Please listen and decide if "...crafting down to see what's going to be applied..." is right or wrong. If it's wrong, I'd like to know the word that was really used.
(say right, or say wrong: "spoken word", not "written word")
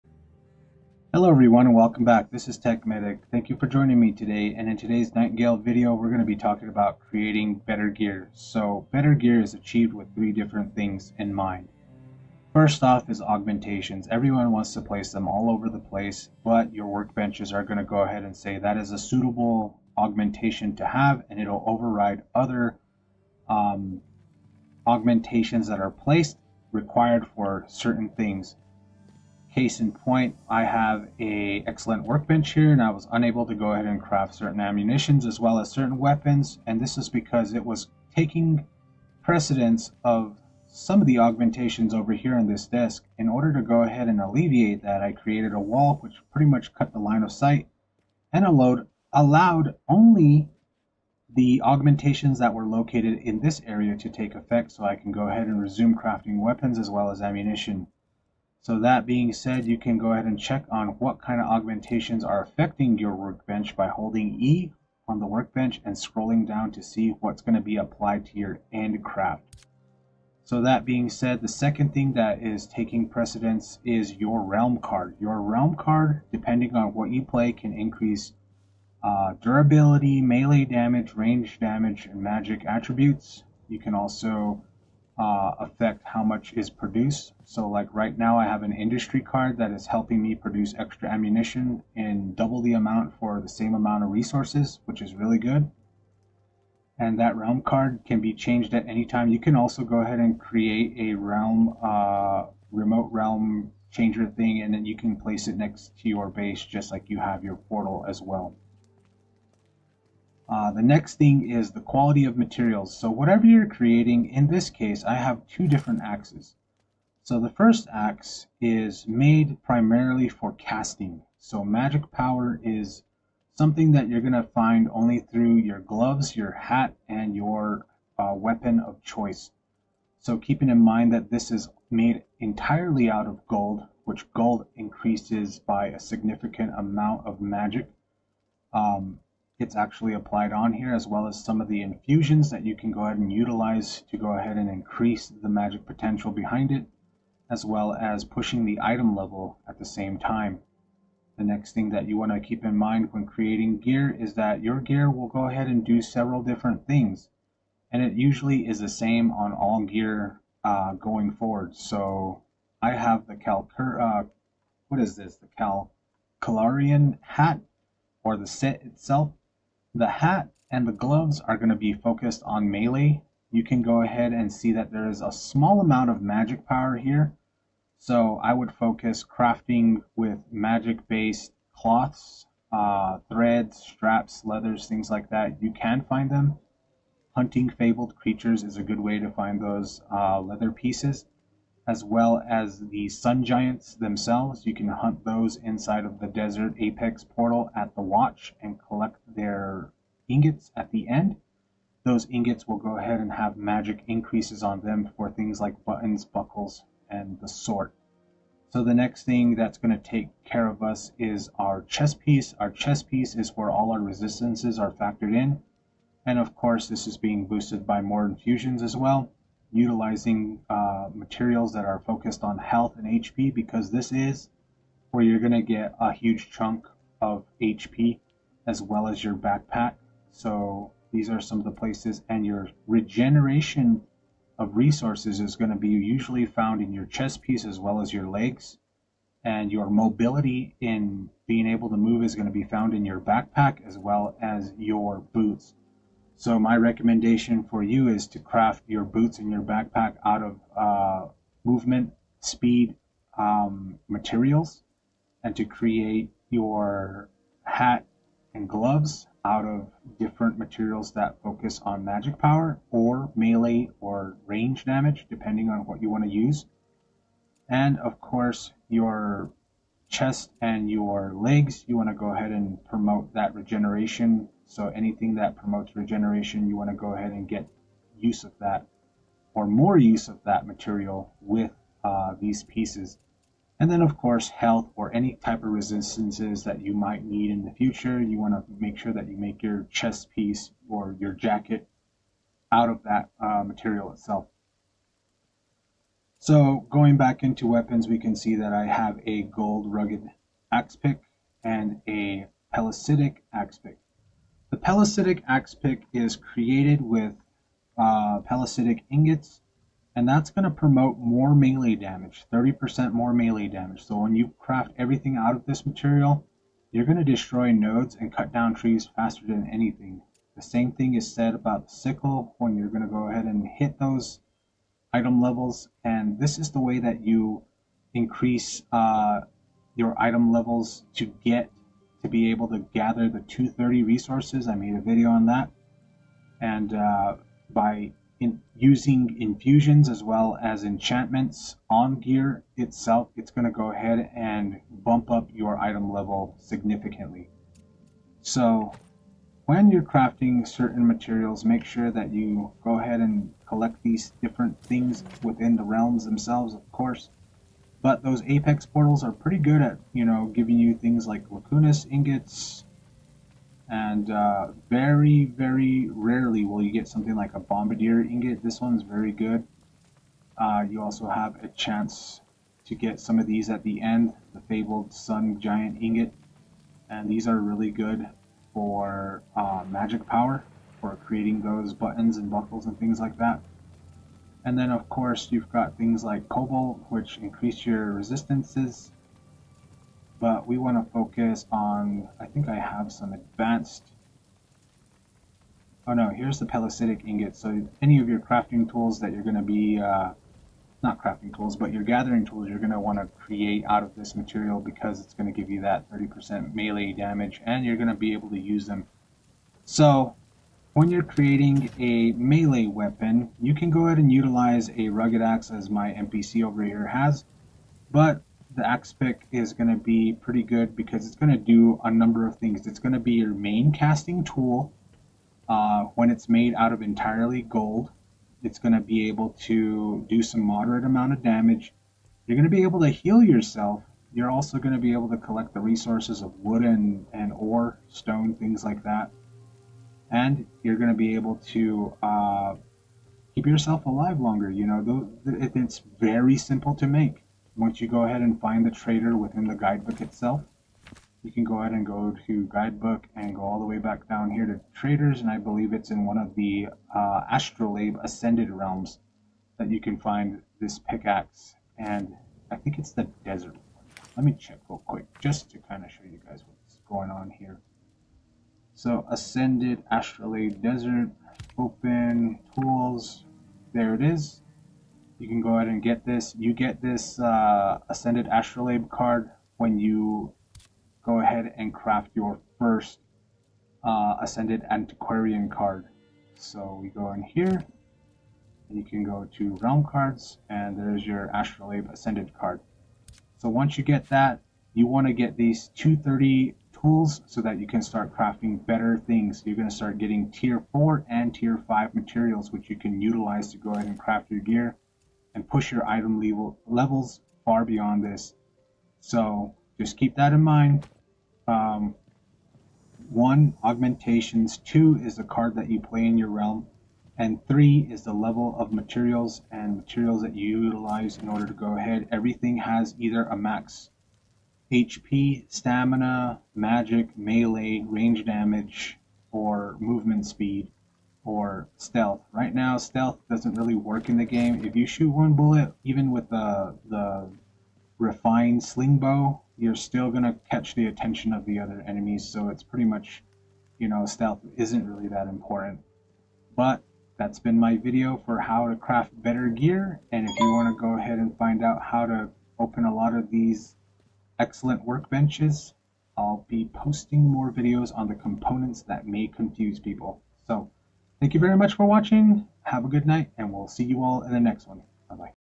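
wrong: "scrolling", not "crafting".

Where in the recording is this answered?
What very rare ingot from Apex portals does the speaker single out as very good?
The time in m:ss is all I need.
6:07.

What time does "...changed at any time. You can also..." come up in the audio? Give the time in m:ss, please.
1:38.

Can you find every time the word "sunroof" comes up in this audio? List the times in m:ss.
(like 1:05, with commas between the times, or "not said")
not said.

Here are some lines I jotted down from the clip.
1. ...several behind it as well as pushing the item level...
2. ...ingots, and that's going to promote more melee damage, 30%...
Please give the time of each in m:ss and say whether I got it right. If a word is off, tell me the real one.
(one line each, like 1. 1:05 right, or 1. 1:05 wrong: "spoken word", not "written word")
1. 2:25 wrong: "potential", not "several"
2. 5:09 right.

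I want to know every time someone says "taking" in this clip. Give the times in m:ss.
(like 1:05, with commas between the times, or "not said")
0:38, 1:12.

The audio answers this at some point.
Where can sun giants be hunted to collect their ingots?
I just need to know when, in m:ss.
3:16.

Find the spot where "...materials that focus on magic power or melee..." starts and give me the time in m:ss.
4:20.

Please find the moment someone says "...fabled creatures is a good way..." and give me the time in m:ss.
3:07.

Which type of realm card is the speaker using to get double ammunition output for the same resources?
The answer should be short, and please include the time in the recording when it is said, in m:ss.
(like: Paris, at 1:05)
Industry card, at 1:28.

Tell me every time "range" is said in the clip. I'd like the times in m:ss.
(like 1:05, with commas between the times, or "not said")
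1:21, 4:24, 8:48.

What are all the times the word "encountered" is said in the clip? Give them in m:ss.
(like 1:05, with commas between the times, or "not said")
not said.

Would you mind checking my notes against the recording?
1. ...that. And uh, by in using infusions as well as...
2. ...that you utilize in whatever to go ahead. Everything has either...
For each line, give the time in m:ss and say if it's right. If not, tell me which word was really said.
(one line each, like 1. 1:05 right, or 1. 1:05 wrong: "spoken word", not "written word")
1. 5:35 right
2. 8:40 wrong: "order", not "whatever".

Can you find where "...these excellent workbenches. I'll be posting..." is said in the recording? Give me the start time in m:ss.
9:13.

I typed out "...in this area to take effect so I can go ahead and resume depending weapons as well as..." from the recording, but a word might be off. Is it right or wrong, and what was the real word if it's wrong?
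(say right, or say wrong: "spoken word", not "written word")
wrong: "crafting", not "depending".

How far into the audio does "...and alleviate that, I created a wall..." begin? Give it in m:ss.
0:44.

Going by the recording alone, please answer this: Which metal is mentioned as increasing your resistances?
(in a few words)
Cobalt.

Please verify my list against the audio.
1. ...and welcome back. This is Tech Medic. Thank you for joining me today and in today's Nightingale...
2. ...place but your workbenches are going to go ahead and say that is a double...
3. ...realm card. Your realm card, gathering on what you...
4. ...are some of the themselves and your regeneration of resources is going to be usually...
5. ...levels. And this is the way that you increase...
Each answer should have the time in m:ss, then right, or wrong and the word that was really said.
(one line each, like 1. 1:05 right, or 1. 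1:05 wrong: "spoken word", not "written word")
1. 0:01 right
2. 0:15 wrong: "suitable", not "double"
3. 1:14 wrong: "depending", not "gathering"
4. 3:51 wrong: "places", not "themselves"
5. 5:25 right.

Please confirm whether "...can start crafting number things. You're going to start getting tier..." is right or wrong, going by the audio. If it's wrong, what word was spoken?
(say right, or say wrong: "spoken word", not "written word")
wrong: "better", not "number".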